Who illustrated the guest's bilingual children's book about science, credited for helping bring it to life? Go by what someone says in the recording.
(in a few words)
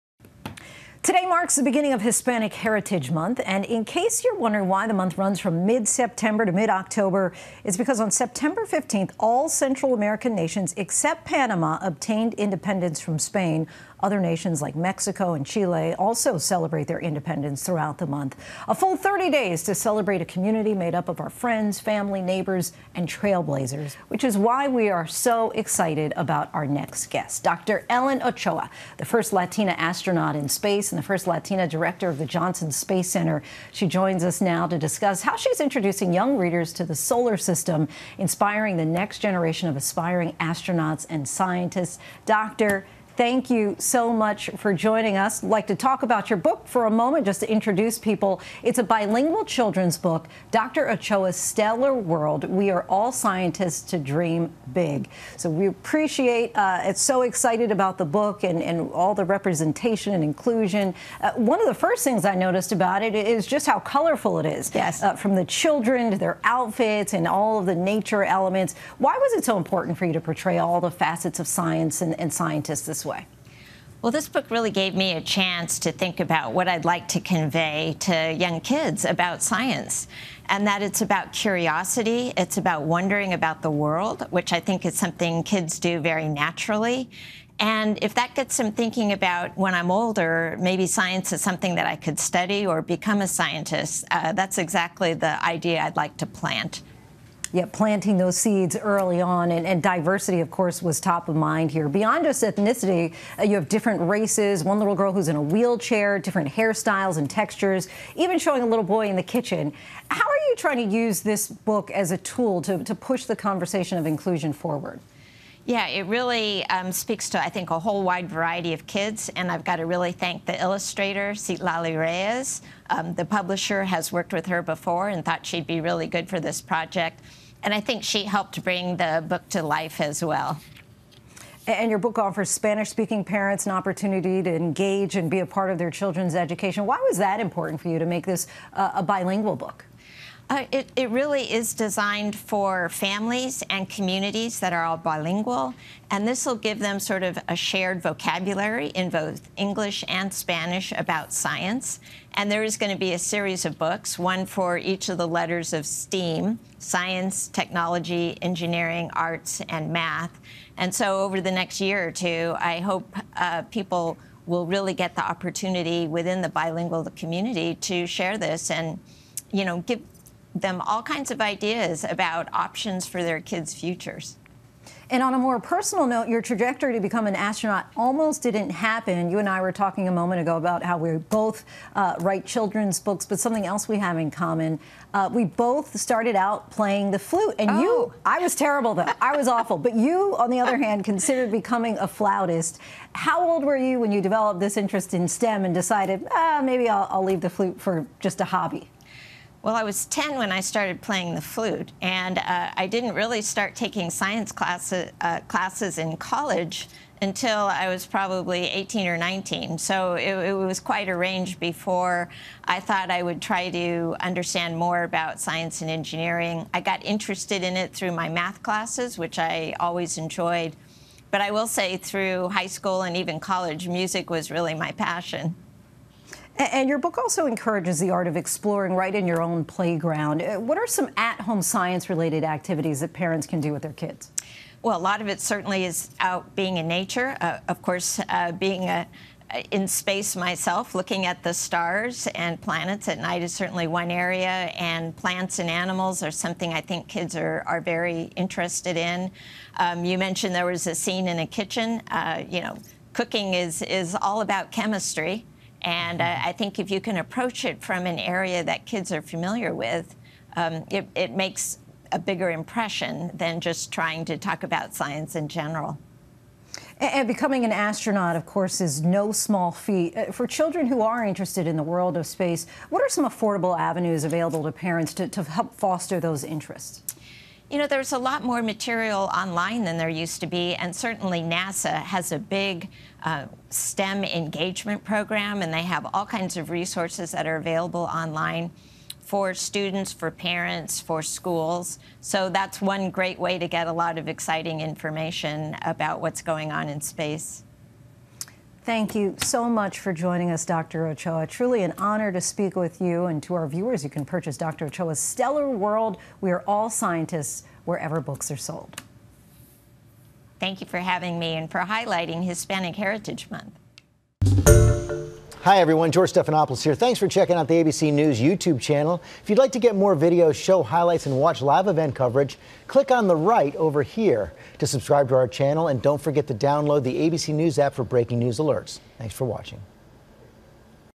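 Citlali Reyes.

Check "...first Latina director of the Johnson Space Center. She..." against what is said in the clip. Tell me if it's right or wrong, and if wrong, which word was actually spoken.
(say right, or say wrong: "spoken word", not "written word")
right.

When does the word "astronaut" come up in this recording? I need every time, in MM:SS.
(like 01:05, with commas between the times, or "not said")
00:29, 00:40, 02:57, 04:27.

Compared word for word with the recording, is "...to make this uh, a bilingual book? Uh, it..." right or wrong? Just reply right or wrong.
right.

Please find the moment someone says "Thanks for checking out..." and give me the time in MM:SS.
05:16.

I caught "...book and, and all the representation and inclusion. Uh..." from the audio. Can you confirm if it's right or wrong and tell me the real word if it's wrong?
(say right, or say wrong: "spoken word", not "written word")
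right.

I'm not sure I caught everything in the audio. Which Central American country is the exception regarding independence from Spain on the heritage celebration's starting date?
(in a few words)
Panama.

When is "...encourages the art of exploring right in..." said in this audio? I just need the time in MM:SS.
03:47.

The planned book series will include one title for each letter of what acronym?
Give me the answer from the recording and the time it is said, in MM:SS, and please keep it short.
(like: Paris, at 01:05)
STEAM, at 02:35.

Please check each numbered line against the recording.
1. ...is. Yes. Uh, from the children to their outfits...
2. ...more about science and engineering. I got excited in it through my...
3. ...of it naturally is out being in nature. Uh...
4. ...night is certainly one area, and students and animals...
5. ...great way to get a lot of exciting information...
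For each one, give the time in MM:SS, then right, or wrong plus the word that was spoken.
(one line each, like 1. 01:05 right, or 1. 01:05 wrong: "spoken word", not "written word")
1. 01:04 right
2. 03:34 wrong: "interested", not "excited"
3. 03:55 wrong: "certainly", not "naturally"
4. 04:03 wrong: "plants", not "students"
5. 04:53 right.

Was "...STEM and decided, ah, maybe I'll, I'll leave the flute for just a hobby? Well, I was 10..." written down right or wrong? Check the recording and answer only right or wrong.
right.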